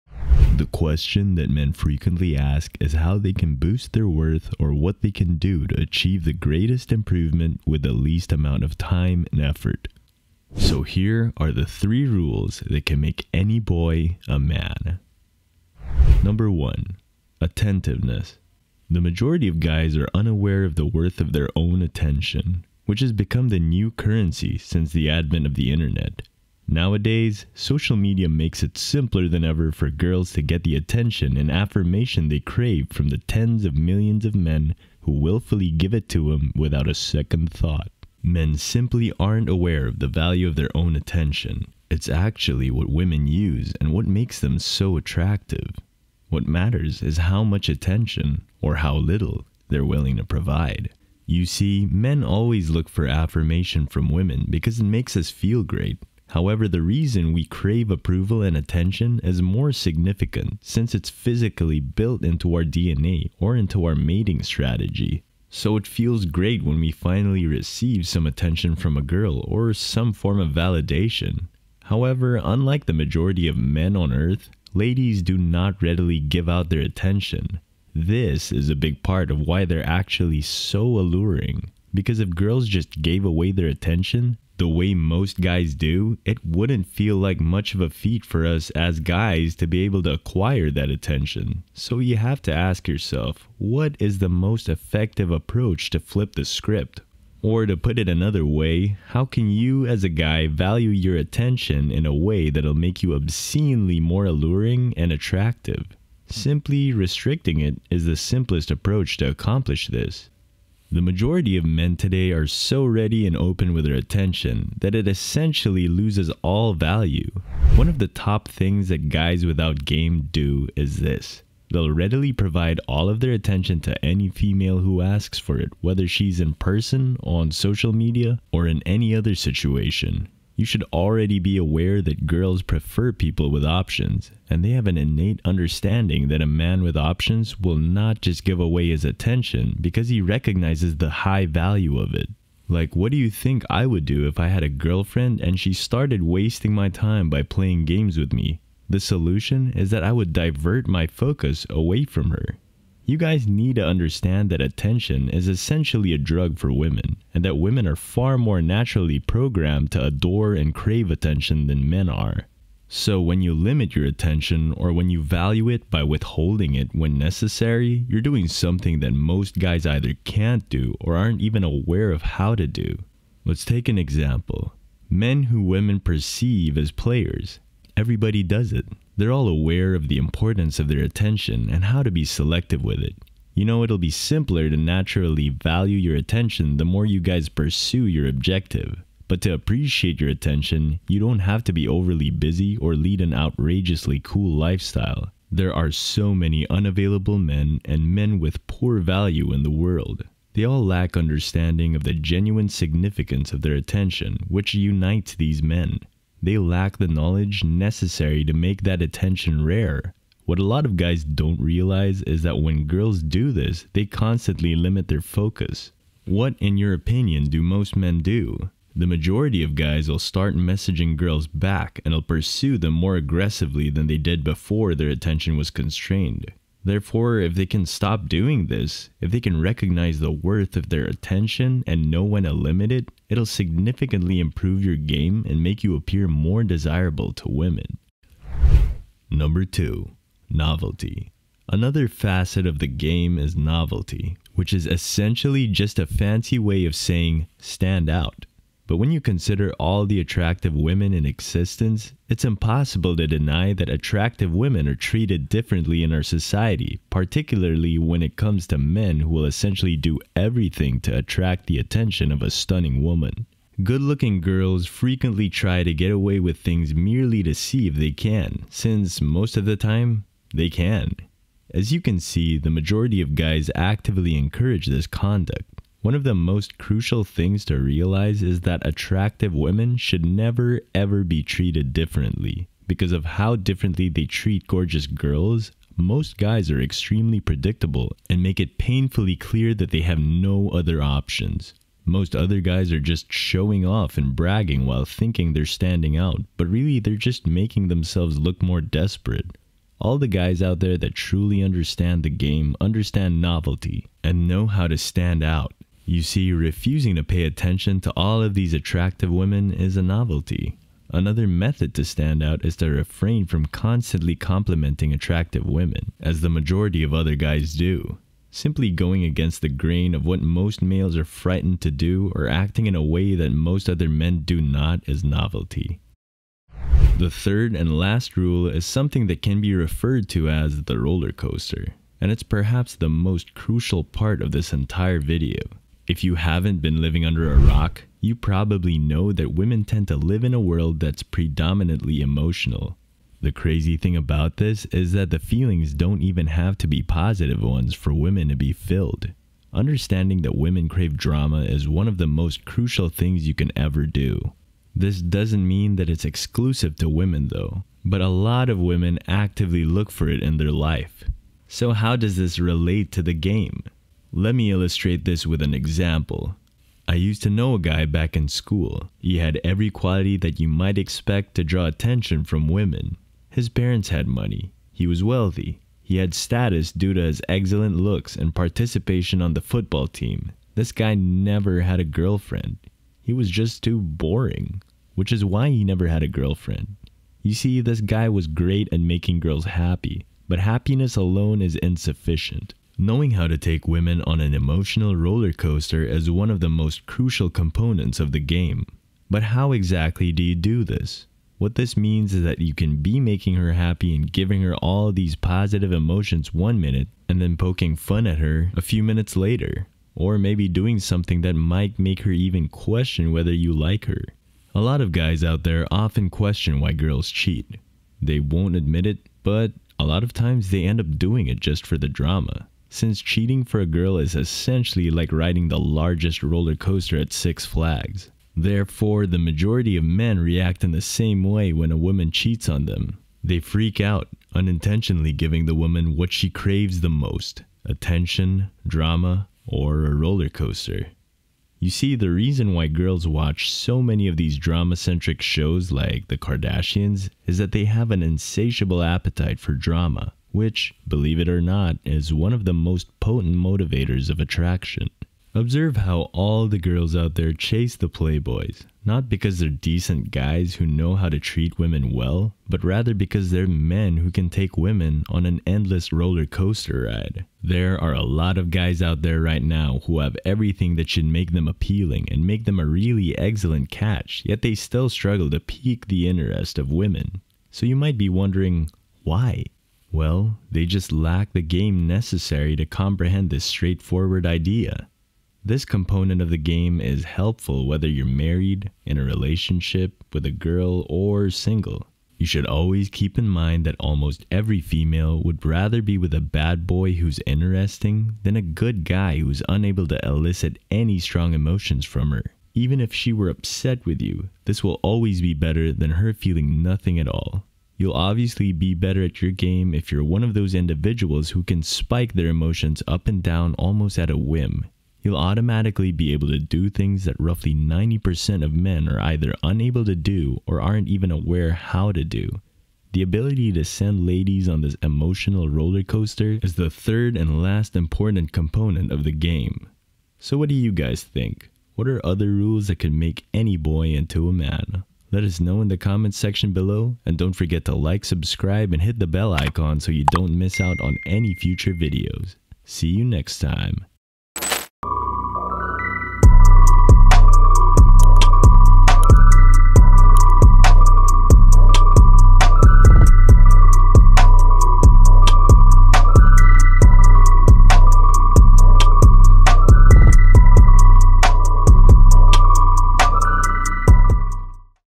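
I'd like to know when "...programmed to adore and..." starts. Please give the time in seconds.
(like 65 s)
159 s.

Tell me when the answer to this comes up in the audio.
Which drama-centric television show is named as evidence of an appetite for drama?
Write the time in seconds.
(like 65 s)
446 s.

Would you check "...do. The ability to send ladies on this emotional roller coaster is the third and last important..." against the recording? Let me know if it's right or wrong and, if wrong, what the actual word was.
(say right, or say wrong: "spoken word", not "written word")
right.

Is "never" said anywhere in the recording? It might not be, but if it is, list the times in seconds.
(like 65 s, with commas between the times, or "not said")
280 s, 381 s, 385 s.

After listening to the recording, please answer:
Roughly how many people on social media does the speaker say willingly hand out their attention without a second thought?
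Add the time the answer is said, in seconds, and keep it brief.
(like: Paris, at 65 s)
tens of millions, at 33 s.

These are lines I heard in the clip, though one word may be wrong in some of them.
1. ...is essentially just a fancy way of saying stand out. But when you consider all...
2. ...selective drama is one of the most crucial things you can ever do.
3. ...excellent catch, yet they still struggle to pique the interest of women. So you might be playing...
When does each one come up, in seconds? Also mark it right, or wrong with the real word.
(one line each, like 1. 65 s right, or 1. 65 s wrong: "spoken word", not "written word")
1. 244 s right
2. 350 s wrong: "crave", not "selective"
3. 473 s wrong: "wondering", not "playing".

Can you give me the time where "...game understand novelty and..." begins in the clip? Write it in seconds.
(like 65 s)
302 s.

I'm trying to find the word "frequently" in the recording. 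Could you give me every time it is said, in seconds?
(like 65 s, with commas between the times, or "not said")
1 s, 264 s.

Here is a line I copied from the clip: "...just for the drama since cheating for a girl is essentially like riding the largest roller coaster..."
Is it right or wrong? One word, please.
right.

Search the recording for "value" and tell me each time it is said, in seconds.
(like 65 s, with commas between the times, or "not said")
40 s, 100 s, 116 s, 141 s, 165 s, 185 s, 198 s.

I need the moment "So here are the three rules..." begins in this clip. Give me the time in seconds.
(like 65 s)
10 s.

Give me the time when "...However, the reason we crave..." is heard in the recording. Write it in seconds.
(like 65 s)
56 s.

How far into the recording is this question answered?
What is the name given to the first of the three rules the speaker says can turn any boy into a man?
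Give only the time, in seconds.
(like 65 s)
17 s.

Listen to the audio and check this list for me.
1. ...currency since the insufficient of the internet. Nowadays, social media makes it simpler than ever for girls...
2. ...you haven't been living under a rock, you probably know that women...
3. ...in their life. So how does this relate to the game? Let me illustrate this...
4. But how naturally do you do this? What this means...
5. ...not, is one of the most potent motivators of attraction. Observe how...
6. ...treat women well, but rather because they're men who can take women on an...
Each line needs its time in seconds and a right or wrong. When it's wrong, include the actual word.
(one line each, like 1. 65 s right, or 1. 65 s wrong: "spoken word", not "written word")
1. 23 s wrong: "advent", not "insufficient"
2. 336 s right
3. 360 s right
4. 399 s wrong: "exactly", not "naturally"
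5. 451 s right
6. 461 s right.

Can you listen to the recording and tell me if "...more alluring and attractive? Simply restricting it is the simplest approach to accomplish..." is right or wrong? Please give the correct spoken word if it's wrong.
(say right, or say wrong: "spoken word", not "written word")
right.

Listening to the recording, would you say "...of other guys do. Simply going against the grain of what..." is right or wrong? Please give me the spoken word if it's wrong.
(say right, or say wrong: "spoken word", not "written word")
right.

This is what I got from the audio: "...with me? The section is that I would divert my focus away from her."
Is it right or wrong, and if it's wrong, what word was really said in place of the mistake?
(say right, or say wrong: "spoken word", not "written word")
wrong: "solution", not "section".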